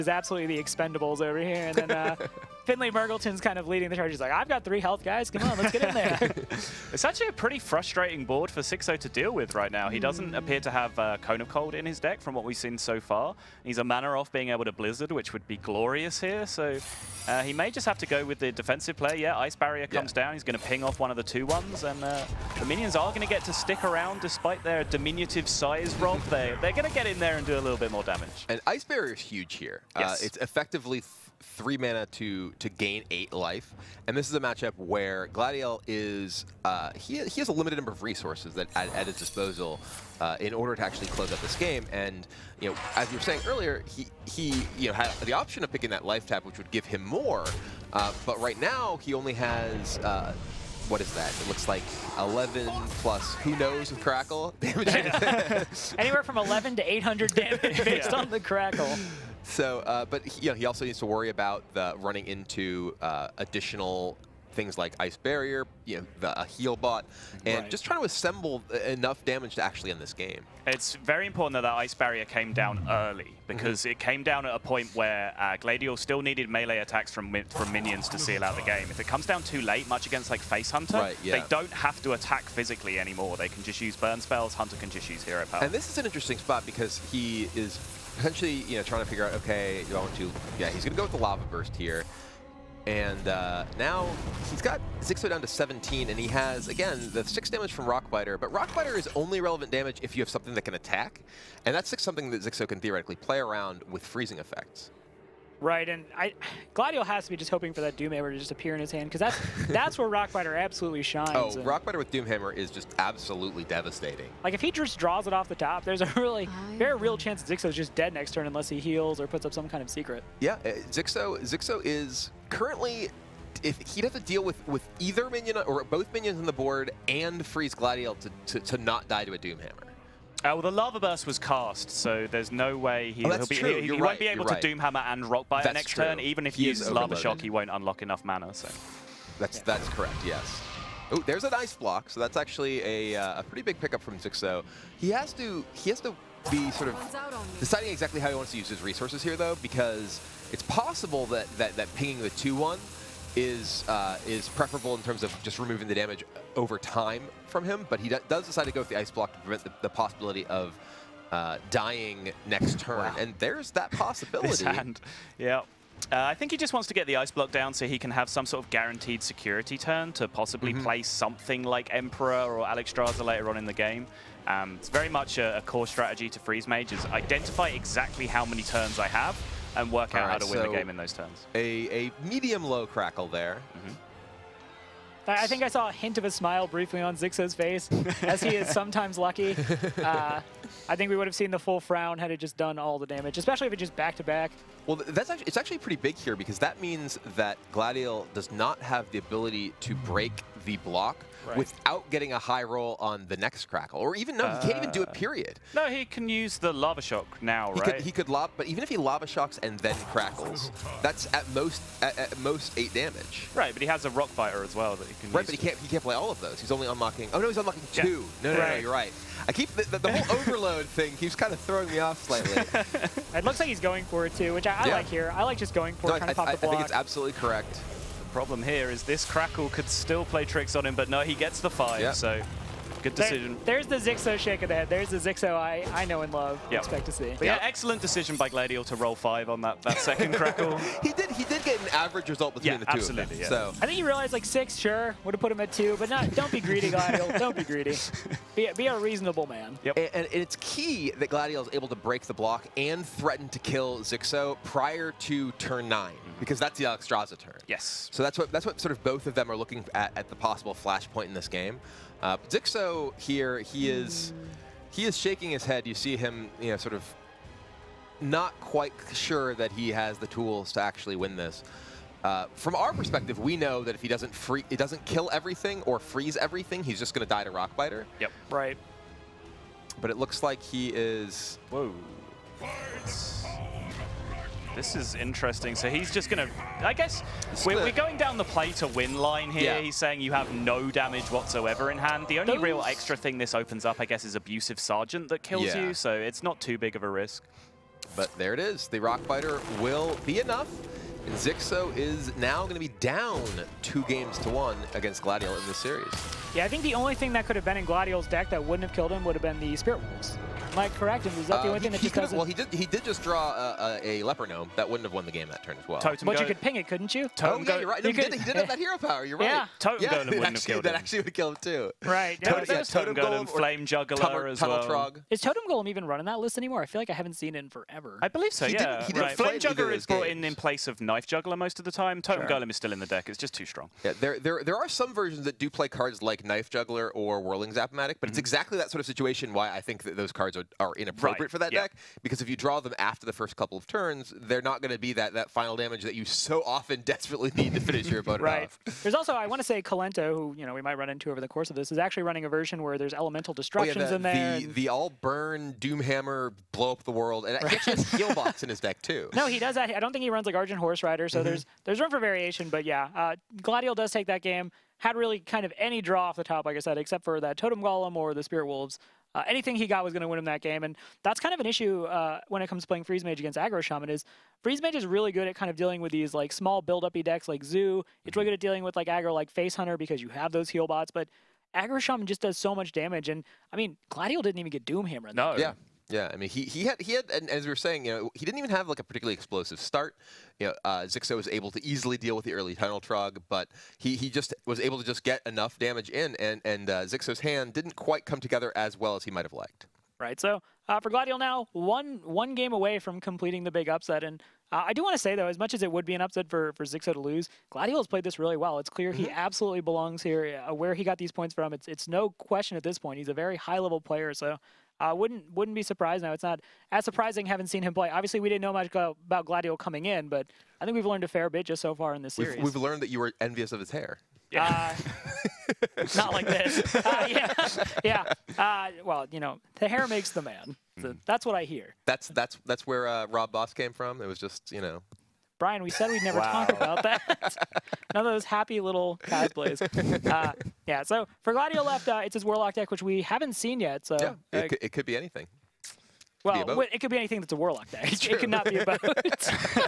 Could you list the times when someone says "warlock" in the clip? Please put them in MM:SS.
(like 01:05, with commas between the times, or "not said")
07:22, 07:27.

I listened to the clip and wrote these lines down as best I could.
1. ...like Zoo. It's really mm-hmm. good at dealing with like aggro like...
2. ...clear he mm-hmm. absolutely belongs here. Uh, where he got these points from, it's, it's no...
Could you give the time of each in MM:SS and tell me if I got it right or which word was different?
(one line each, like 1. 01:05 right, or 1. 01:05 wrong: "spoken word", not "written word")
1. 06:17 right
2. 06:48 right.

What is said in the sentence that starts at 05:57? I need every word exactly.
he actually has box in his deck, too.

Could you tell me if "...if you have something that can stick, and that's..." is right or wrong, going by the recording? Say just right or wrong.
wrong.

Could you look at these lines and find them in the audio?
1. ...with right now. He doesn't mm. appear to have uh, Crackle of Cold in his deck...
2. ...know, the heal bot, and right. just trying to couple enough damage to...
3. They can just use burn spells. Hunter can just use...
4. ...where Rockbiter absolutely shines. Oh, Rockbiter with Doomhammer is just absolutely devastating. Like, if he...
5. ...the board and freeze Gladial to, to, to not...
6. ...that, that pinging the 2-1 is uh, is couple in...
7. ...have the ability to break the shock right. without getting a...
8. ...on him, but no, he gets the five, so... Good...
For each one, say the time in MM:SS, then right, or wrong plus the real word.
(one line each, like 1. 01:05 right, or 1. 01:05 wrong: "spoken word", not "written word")
1. 00:09 wrong: "Cone", not "Crackle"
2. 01:05 wrong: "assemble", not "couple"
3. 01:23 right
4. 01:49 right
5. 02:06 right
6. 02:31 wrong: "preferable", not "couple"
7. 03:18 wrong: "block", not "shock"
8. 03:50 right.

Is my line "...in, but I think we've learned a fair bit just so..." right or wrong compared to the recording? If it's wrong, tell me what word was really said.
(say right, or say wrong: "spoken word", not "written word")
right.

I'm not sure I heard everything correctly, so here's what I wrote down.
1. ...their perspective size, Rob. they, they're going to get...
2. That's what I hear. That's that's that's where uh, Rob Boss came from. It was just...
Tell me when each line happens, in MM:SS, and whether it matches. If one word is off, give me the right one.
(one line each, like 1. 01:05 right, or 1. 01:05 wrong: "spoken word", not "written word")
1. 00:24 wrong: "diminutive", not "perspective"
2. 07:11 right.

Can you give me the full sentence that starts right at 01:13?
it came down at a point where uh, still needed melee attacks from from minions to seal out the game.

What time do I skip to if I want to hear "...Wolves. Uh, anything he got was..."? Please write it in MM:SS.
06:08.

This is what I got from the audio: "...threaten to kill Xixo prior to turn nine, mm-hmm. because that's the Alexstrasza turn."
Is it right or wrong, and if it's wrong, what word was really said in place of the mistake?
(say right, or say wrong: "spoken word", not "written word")
right.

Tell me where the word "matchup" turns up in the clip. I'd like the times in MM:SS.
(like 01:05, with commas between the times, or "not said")
00:34.